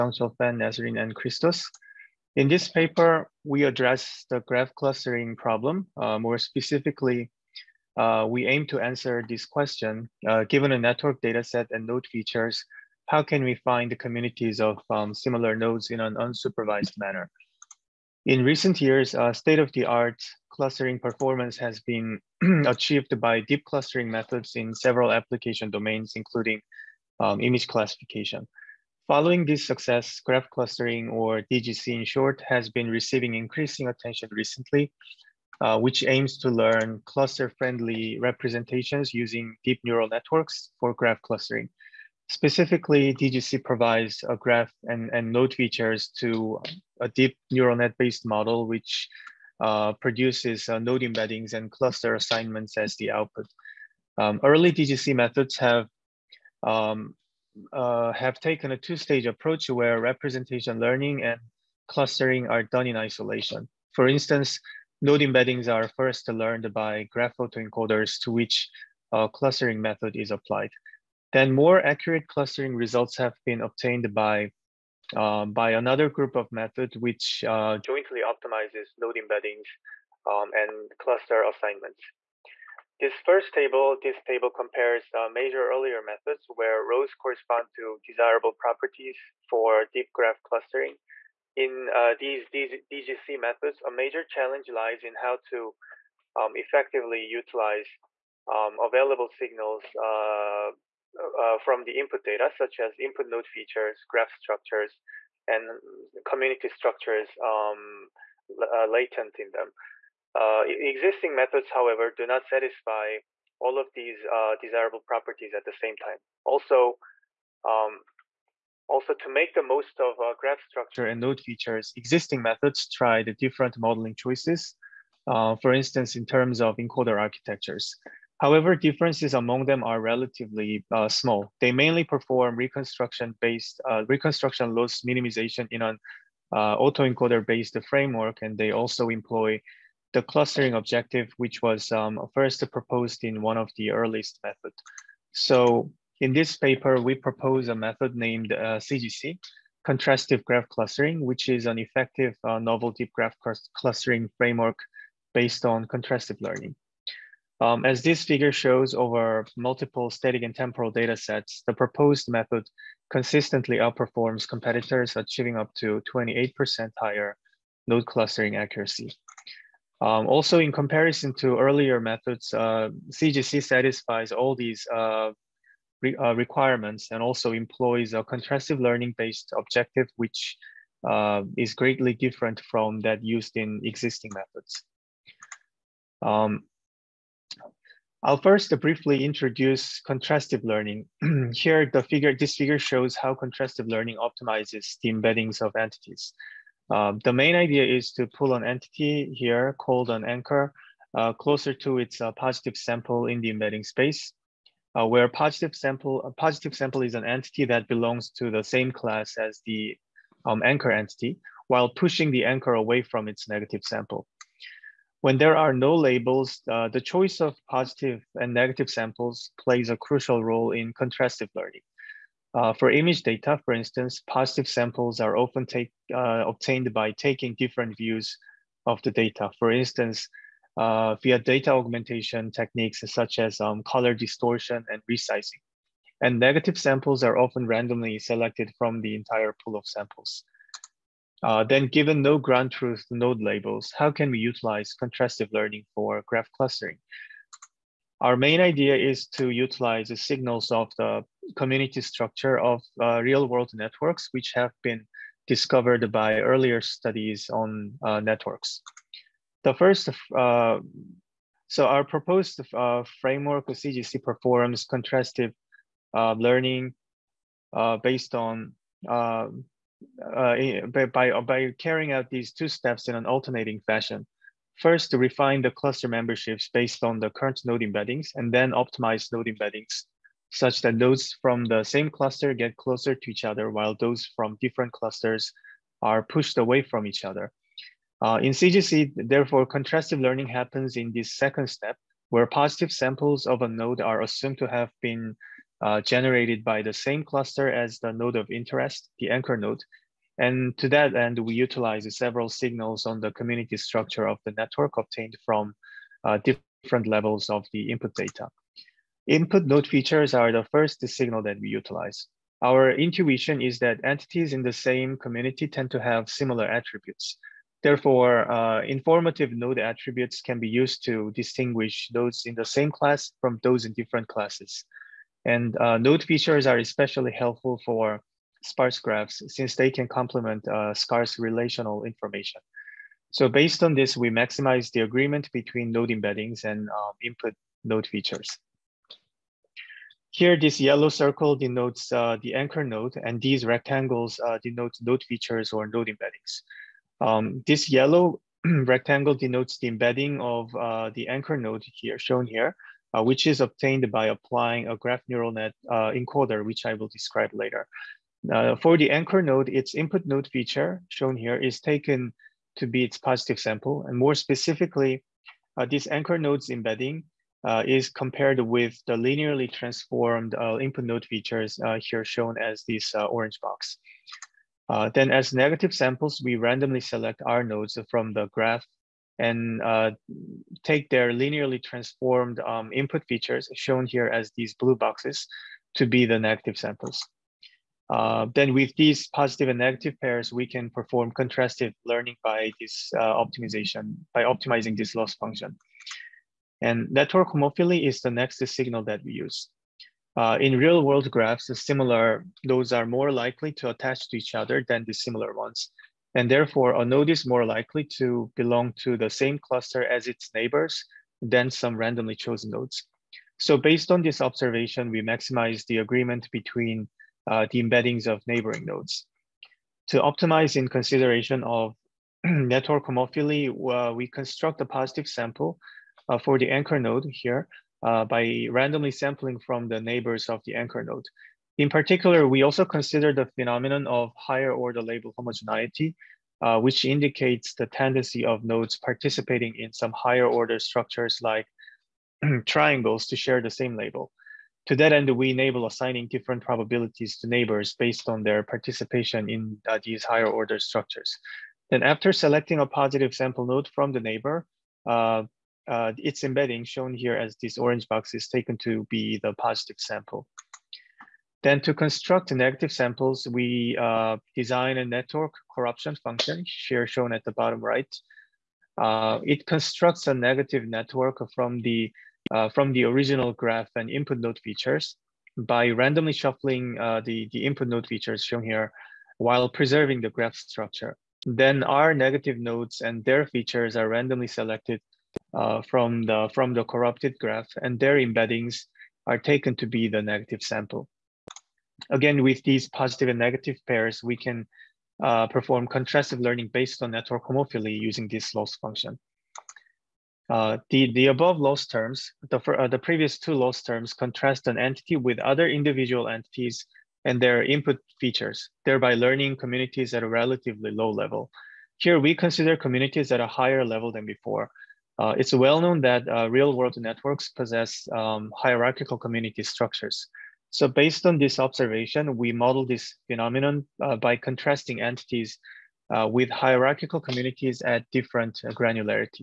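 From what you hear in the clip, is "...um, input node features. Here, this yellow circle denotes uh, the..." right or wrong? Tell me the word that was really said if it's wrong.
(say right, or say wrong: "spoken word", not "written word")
right.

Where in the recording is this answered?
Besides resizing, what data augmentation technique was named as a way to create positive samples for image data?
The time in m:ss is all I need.
3:53.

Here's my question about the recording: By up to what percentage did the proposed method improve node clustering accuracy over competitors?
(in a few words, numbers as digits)
28%.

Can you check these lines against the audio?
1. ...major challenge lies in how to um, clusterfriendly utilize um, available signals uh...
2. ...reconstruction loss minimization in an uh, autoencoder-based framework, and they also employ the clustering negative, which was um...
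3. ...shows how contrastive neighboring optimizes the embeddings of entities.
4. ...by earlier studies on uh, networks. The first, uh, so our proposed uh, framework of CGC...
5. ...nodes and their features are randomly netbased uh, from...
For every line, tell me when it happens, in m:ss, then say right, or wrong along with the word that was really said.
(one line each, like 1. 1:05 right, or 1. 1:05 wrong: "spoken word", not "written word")
1. 1:33 wrong: "effectively", not "clusterfriendly"
2. 2:14 wrong: "objective", not "negative"
3. 3:12 wrong: "learning", not "neighboring"
4. 4:16 right
5. 8:02 wrong: "selected", not "netbased".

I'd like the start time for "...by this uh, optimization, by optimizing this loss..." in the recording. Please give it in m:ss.
6:32.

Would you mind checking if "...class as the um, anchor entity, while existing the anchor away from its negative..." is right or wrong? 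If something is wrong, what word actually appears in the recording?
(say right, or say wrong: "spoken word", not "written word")
wrong: "pushing", not "existing".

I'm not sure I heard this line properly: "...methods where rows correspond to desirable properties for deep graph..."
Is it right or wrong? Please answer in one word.
right.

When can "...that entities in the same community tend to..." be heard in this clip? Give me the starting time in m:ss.
5:13.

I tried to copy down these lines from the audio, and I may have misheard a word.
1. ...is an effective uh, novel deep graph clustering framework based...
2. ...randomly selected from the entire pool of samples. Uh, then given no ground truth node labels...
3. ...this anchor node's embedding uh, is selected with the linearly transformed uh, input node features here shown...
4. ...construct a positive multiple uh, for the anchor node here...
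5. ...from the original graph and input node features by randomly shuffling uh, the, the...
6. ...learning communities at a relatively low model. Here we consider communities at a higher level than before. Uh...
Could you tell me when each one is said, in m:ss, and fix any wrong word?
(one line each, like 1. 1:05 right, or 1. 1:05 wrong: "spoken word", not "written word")
1. 2:31 right
2. 3:57 right
3. 6:05 wrong: "compared", not "selected"
4. 7:04 wrong: "sample", not "multiple"
5. 7:52 right
6. 8:29 wrong: "level", not "model".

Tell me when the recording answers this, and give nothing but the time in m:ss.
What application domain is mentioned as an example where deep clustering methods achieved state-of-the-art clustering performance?
0:27.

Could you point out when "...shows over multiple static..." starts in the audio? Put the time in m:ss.
2:38.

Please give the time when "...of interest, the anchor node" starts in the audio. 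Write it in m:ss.
4:58.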